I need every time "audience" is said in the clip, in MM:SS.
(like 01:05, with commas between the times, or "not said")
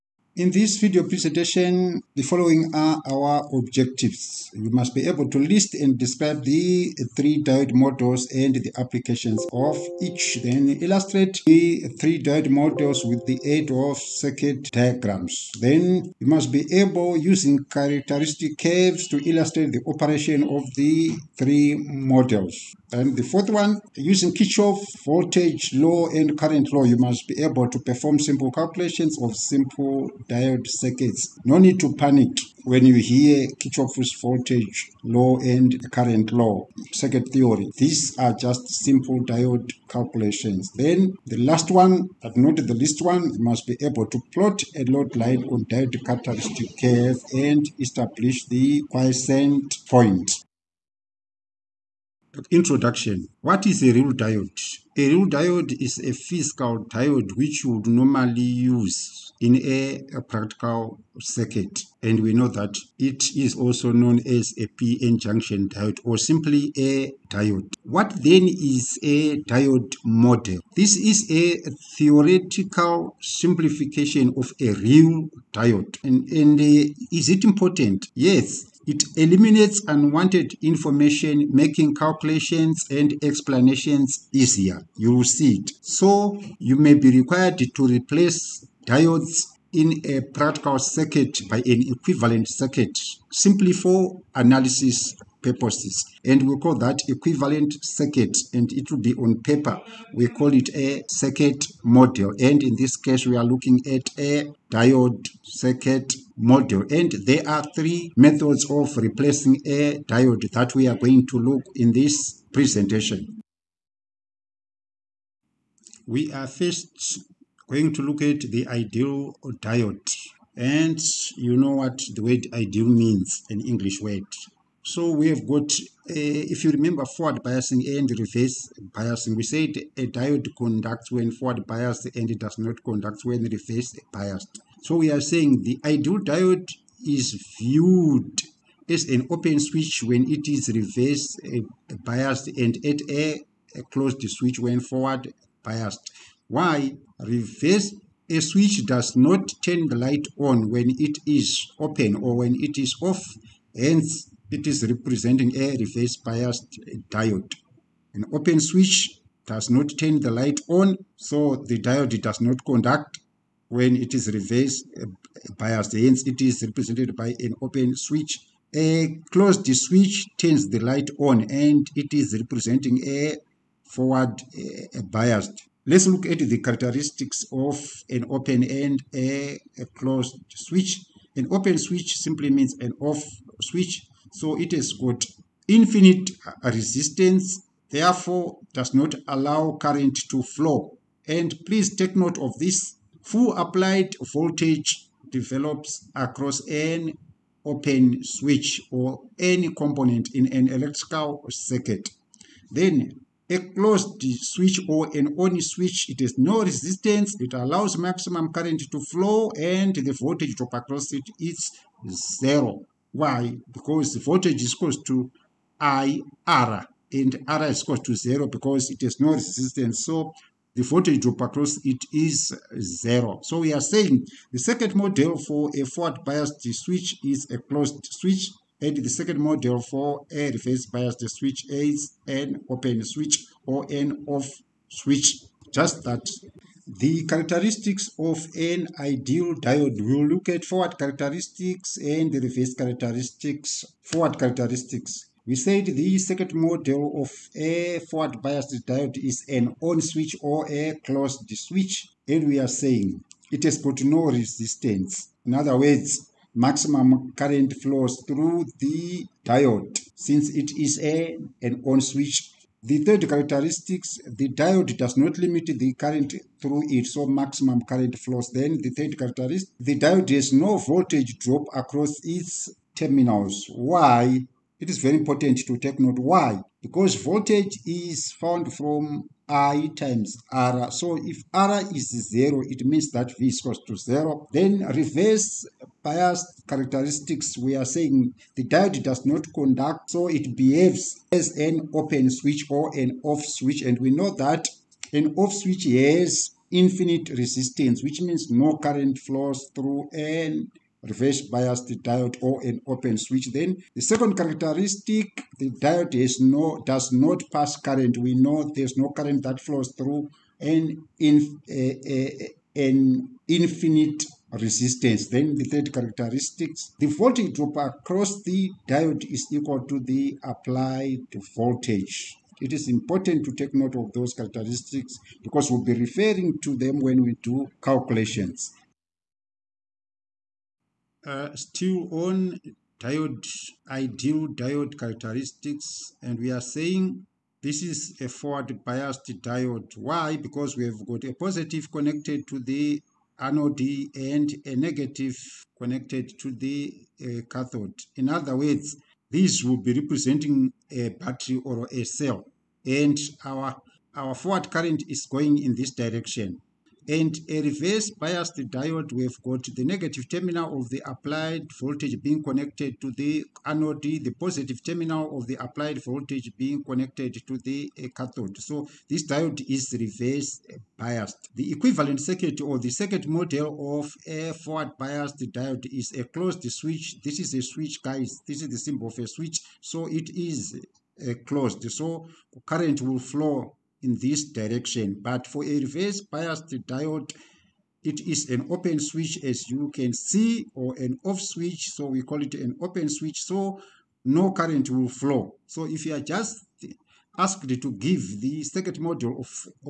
not said.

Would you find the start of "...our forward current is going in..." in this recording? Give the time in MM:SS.
05:54.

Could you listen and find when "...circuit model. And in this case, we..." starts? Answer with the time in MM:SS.
01:41.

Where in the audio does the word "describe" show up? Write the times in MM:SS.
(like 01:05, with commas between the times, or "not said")
00:05.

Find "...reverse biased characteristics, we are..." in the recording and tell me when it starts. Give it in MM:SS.
04:44.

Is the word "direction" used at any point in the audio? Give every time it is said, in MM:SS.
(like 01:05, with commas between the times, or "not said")
05:55, 06:24.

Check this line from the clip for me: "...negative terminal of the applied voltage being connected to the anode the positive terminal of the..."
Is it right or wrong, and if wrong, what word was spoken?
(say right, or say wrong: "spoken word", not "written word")
right.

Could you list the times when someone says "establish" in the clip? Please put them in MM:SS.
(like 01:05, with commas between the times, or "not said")
00:47.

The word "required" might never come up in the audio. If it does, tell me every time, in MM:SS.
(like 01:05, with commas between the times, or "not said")
01:27.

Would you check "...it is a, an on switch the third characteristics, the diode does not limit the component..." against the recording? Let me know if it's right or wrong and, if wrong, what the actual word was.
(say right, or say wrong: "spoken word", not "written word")
wrong: "current", not "component".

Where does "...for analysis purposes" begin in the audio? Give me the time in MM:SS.
01:33.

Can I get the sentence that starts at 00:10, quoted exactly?
Then illustrate the three diode models with the aid of circuit diagrams.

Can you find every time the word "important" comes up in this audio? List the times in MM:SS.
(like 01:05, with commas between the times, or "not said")
01:17, 04:35, 05:22.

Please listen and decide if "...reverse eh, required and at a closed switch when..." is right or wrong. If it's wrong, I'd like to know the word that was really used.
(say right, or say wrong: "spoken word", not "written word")
wrong: "biased", not "required".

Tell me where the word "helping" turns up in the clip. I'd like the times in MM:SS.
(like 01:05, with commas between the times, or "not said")
not said.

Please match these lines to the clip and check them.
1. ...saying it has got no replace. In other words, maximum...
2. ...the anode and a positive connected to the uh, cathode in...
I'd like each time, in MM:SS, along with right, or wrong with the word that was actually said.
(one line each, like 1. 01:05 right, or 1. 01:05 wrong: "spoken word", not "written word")
1. 04:12 wrong: "resistance", not "replace"
2. 05:42 wrong: "negative", not "positive".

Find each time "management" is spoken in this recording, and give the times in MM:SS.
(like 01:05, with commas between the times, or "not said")
not said.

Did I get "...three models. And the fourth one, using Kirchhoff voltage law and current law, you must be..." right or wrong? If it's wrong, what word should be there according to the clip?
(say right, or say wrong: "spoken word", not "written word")
right.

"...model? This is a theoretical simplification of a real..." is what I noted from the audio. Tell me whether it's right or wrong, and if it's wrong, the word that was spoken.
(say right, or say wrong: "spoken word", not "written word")
right.